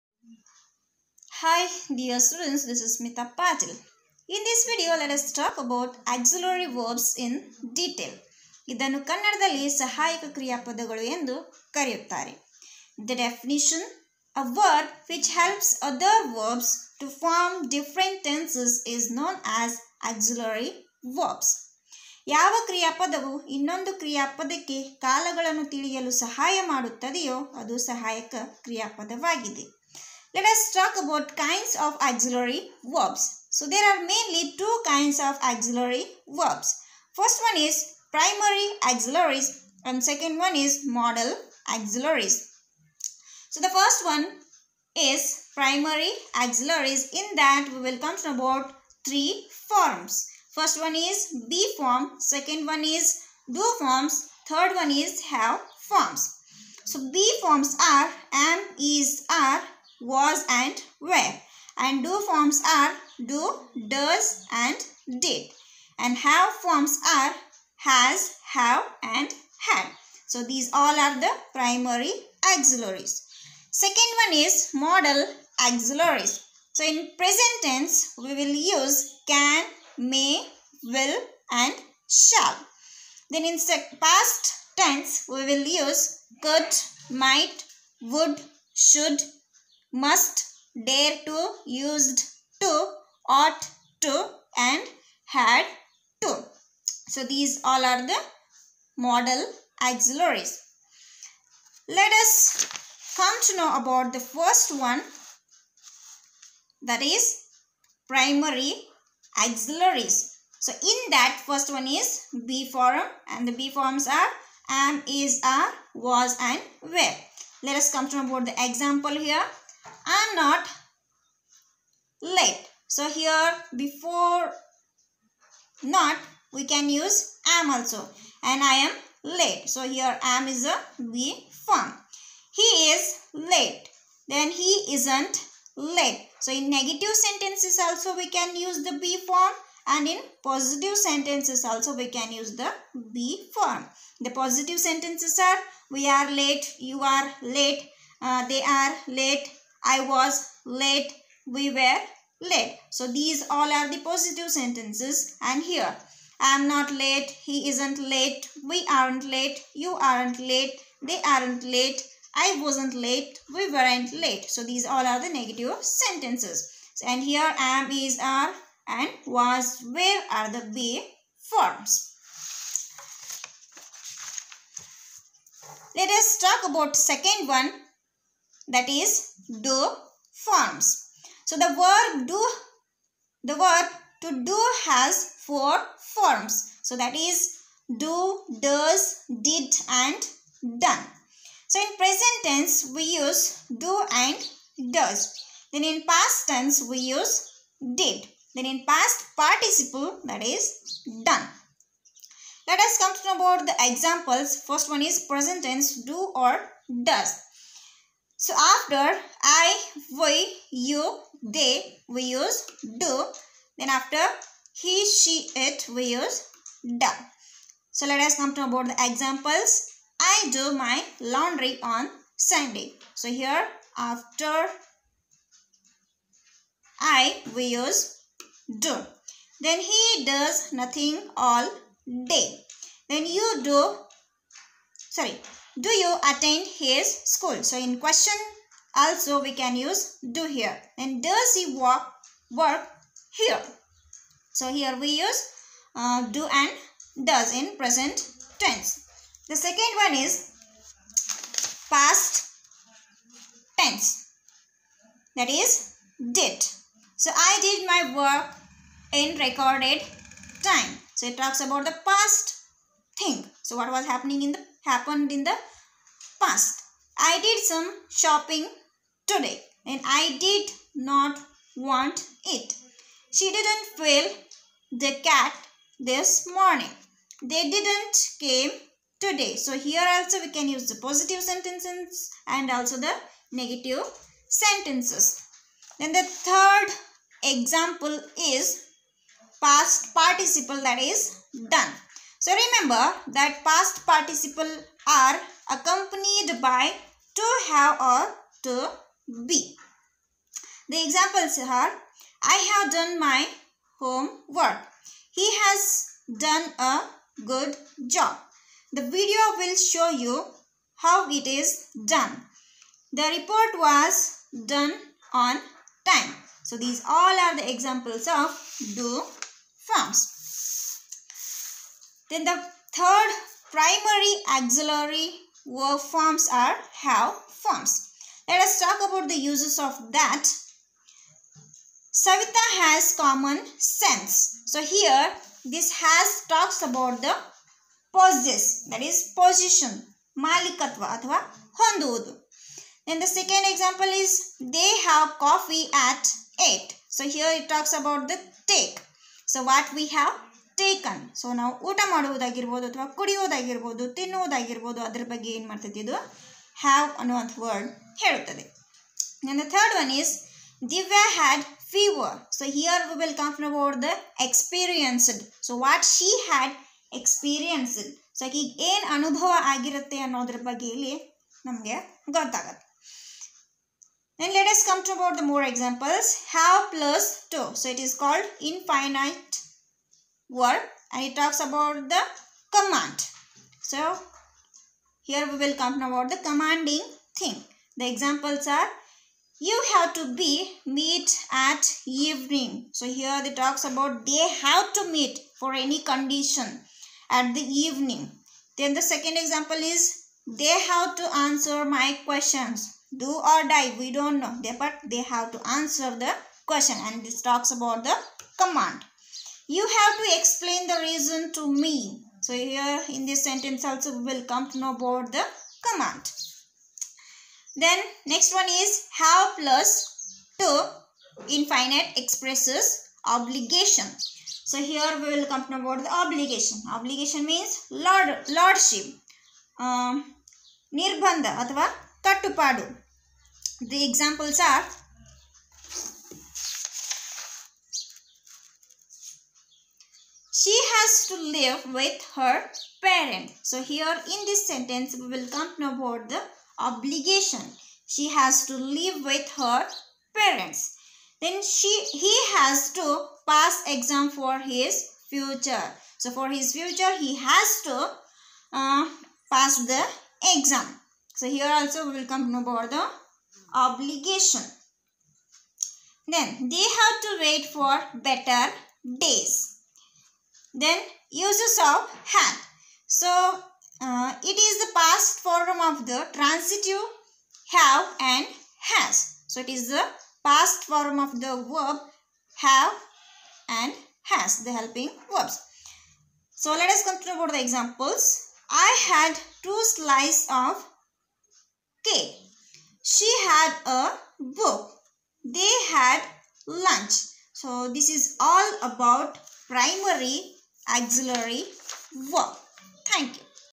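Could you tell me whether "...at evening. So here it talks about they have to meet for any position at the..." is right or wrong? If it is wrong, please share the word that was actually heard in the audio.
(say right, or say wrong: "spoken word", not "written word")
wrong: "condition", not "position".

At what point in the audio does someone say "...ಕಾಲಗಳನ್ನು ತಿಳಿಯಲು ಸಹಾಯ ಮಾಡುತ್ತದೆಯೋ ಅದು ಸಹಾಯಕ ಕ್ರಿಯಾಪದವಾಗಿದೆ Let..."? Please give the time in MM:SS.
00:25.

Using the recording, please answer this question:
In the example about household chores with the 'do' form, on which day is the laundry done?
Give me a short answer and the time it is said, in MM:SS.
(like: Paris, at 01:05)
Sunday, at 03:42.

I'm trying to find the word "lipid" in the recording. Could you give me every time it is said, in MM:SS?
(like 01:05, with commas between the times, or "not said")
not said.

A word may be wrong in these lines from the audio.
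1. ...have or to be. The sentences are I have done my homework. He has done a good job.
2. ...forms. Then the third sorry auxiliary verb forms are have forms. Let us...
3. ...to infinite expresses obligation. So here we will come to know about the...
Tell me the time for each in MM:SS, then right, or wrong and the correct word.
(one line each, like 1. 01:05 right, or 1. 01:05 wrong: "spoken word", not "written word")
1. 04:57 wrong: "examples", not "sentences"
2. 05:19 wrong: "primary", not "sorry"
3. 07:00 right.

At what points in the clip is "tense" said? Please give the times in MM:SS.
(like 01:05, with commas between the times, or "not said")
01:17, 01:24, 03:12, 03:16, 03:25, 04:08, 04:13.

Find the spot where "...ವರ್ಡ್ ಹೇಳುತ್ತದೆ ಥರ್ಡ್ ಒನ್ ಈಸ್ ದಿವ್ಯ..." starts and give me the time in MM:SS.
05:57.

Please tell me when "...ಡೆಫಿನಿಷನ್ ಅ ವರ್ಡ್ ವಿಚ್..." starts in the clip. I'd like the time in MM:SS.
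00:13.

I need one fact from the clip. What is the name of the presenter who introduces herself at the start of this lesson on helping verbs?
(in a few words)
Smita Patil.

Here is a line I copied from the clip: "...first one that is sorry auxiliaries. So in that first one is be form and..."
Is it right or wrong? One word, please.
wrong.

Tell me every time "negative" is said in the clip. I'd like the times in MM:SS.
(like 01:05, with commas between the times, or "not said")
02:16, 02:45, 04:43.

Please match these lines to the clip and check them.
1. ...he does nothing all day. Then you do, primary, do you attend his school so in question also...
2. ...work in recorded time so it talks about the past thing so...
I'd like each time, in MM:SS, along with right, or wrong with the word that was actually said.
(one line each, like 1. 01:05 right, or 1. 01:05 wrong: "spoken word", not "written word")
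1. 03:49 wrong: "sorry", not "primary"
2. 04:18 right.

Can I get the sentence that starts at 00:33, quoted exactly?
So there are mainly two kinds of auxiliary verbs.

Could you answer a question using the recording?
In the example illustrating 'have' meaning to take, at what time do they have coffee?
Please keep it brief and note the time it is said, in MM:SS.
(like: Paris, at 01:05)
8, at 05:46.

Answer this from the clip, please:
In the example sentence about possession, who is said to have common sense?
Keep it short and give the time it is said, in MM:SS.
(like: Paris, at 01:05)
Savita, at 05:32.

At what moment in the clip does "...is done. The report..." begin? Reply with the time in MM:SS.
05:11.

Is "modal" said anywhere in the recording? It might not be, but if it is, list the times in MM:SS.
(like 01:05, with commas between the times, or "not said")
00:40, 01:14, 01:38.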